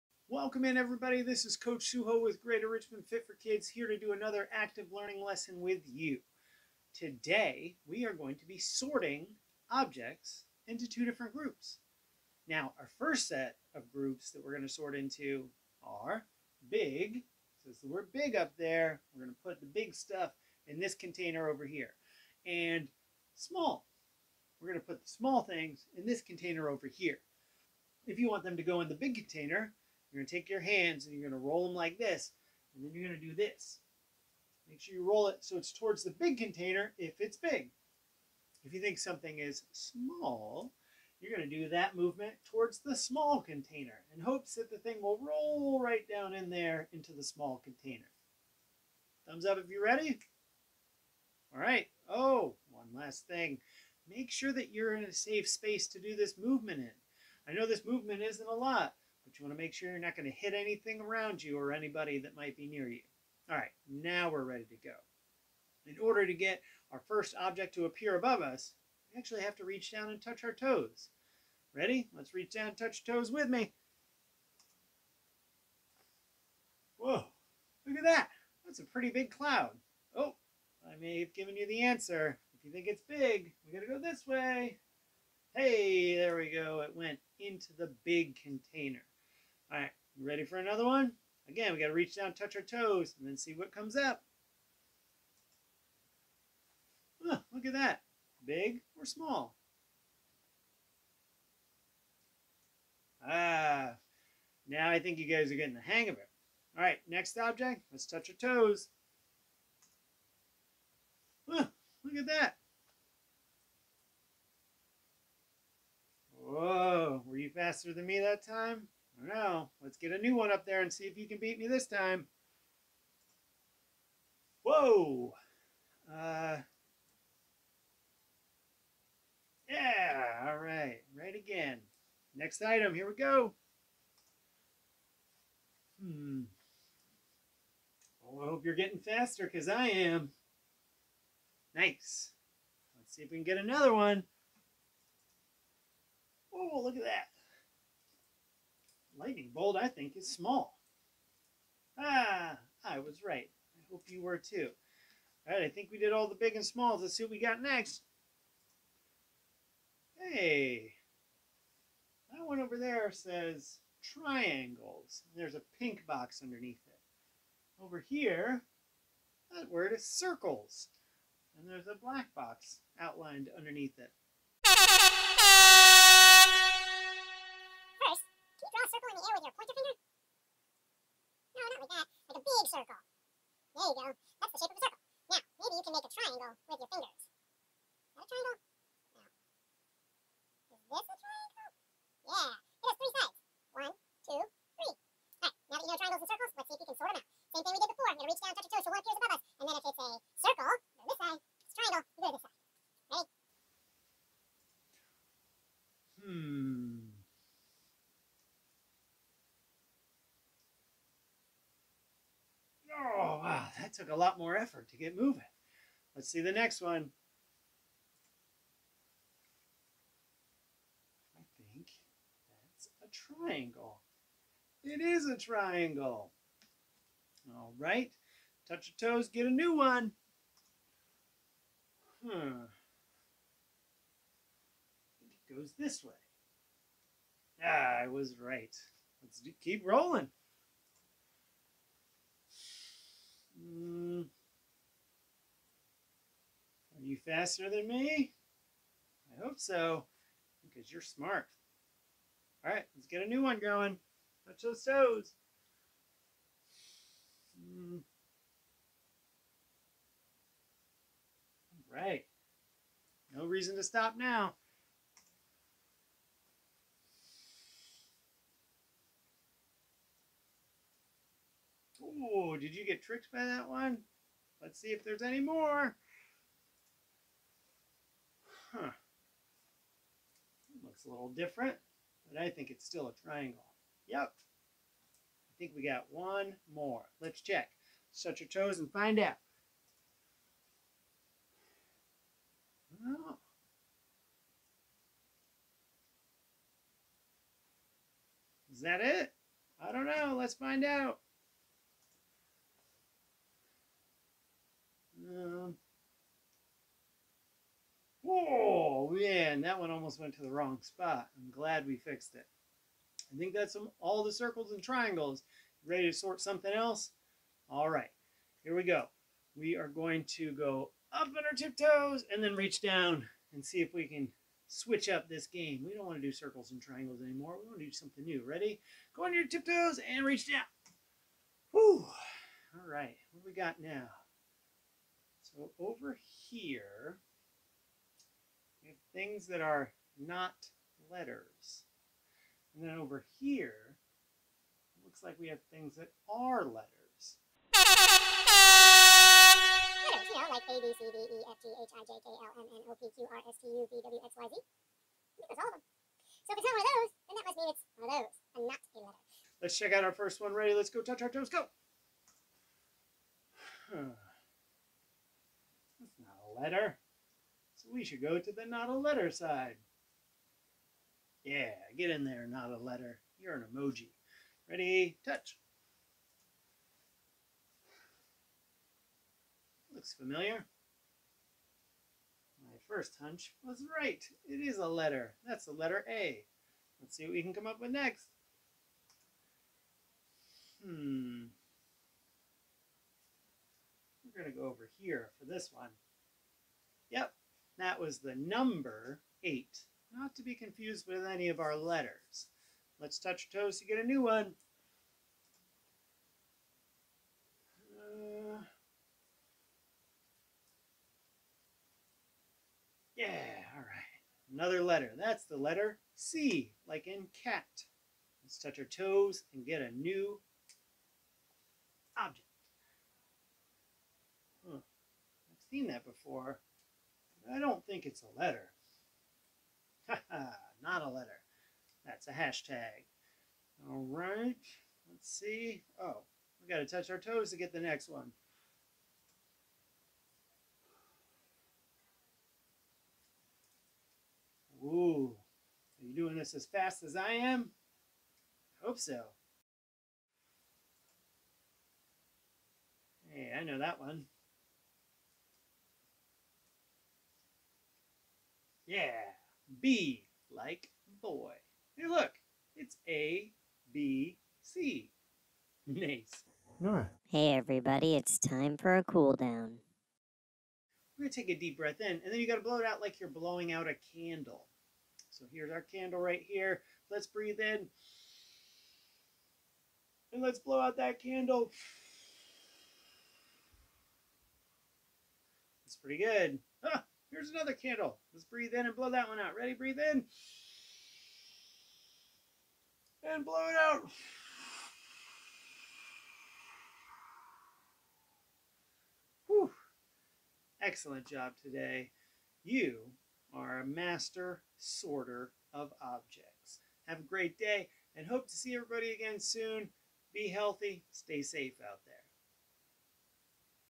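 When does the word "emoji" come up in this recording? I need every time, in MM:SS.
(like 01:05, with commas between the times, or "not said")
06:13.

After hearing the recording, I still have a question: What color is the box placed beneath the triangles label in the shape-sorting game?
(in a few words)
pink.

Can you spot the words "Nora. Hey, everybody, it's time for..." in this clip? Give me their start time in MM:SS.
07:46.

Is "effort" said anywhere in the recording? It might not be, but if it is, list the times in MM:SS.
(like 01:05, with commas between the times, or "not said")
03:34.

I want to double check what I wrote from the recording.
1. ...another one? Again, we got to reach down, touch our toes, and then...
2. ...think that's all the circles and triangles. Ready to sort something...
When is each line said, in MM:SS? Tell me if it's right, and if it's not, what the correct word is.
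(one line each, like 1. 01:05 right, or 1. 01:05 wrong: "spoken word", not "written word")
1. 01:30 right
2. 05:13 right.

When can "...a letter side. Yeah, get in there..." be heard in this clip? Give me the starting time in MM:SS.
06:08.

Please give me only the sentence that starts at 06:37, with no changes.
Yep, that was the number 8, not to be confused with any of our letters.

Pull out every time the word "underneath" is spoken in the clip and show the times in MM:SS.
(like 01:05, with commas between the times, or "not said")
02:46, 02:53.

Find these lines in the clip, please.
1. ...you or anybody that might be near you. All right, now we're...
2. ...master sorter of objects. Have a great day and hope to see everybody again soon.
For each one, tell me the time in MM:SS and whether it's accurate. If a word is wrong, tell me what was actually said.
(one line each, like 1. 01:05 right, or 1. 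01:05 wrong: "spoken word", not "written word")
1. 01:01 right
2. 08:23 right.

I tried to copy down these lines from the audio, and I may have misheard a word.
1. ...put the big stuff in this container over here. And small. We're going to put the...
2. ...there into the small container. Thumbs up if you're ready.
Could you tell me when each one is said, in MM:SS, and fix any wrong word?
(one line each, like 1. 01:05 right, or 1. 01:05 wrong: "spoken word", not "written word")
1. 00:19 right
2. 00:46 right.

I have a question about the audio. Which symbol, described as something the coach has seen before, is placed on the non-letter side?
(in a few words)
hashtag.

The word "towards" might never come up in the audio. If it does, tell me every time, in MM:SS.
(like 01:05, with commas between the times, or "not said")
00:35, 00:42.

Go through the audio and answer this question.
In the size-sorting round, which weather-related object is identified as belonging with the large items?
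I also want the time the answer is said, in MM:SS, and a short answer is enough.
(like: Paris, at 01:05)
cloud, at 01:19.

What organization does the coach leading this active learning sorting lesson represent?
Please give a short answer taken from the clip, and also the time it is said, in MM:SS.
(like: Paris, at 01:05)
Greater Richmond Fit for Kids, at 00:02.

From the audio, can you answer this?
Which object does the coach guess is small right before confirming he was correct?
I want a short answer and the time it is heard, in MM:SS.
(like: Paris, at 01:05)
Lightning bolt, at 02:29.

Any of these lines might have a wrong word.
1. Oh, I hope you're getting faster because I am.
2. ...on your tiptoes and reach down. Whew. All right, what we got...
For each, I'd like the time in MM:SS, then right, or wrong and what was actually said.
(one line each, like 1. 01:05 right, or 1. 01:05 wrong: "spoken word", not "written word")
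1. 02:18 right
2. 05:29 right.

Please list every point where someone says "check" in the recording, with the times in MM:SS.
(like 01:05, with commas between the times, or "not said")
04:47, 05:59.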